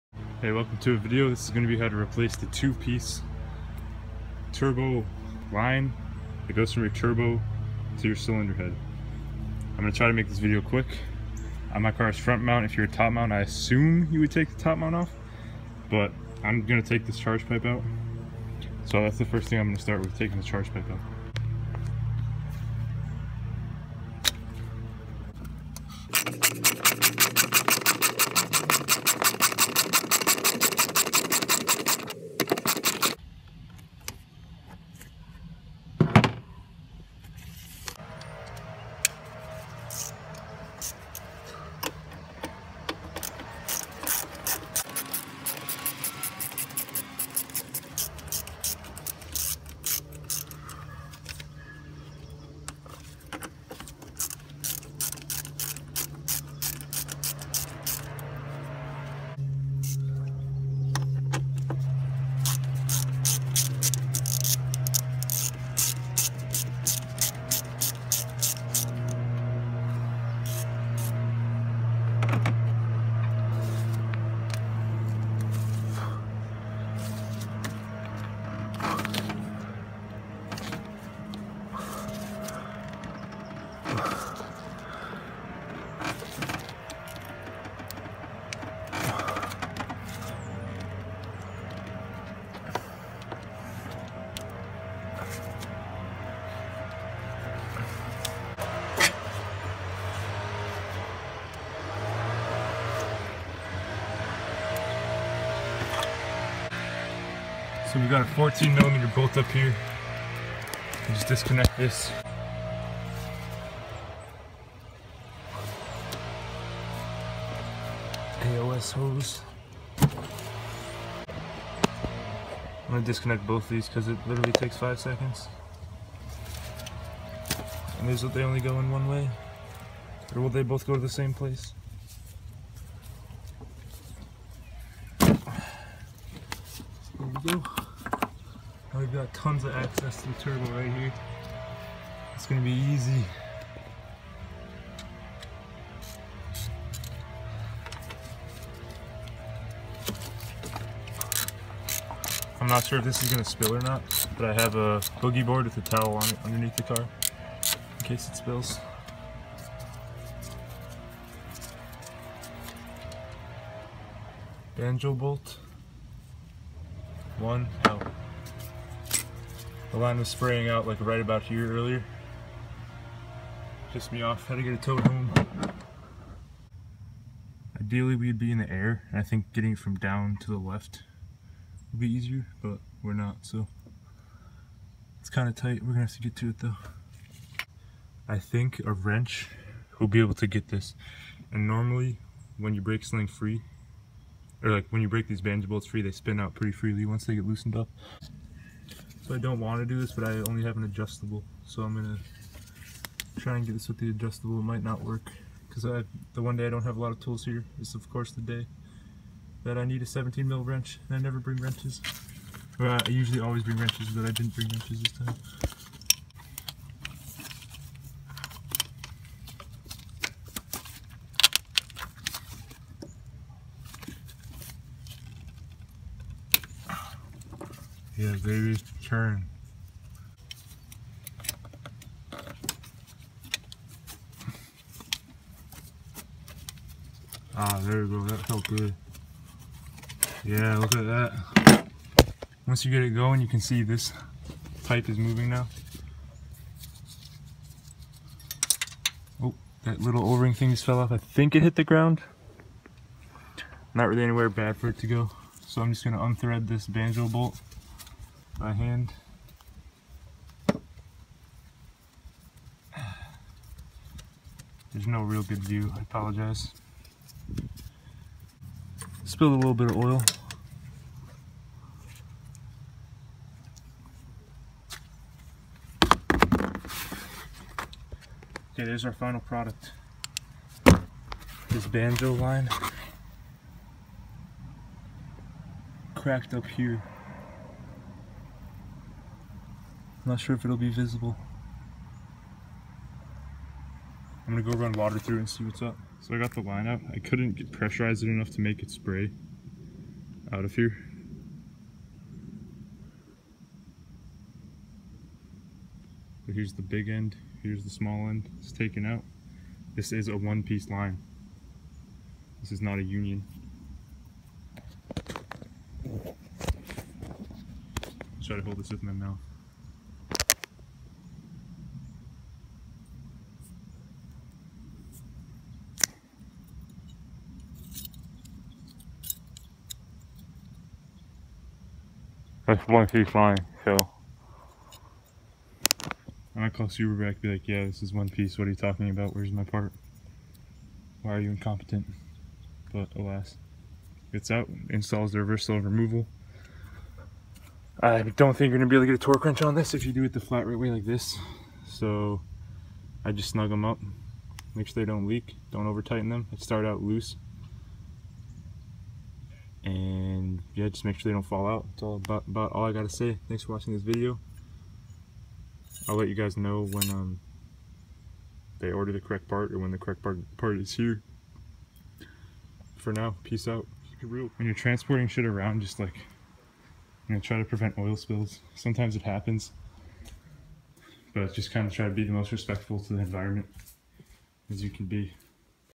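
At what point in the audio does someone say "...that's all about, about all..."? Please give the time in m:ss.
6:01.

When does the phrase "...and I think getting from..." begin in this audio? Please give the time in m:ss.
2:59.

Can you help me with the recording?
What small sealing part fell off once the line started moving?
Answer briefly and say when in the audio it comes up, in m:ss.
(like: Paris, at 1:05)
o-ring, at 4:10.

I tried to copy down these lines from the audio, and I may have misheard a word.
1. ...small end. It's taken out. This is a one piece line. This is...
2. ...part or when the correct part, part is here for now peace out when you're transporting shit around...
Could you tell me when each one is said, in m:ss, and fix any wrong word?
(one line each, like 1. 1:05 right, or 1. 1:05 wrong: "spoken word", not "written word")
1. 5:07 right
2. 6:09 right.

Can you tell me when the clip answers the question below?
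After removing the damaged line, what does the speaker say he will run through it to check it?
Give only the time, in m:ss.
4:54.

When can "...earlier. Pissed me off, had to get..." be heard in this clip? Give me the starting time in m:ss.
2:51.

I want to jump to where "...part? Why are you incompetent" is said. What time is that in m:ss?
5:39.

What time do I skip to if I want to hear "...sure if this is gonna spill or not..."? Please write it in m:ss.
2:32.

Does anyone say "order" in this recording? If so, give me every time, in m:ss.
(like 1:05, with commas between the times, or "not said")
6:08.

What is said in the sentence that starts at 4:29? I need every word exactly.
Spilled a little bit of oil.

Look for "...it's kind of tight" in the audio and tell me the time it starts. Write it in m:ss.
3:05.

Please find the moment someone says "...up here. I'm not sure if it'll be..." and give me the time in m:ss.
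4:46.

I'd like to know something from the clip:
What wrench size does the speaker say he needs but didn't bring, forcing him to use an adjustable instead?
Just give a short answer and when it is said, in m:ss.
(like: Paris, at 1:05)
17 mil, at 3:30.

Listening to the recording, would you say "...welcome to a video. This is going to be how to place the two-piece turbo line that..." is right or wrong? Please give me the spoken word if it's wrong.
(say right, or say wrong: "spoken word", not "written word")
wrong: "replace", not "place".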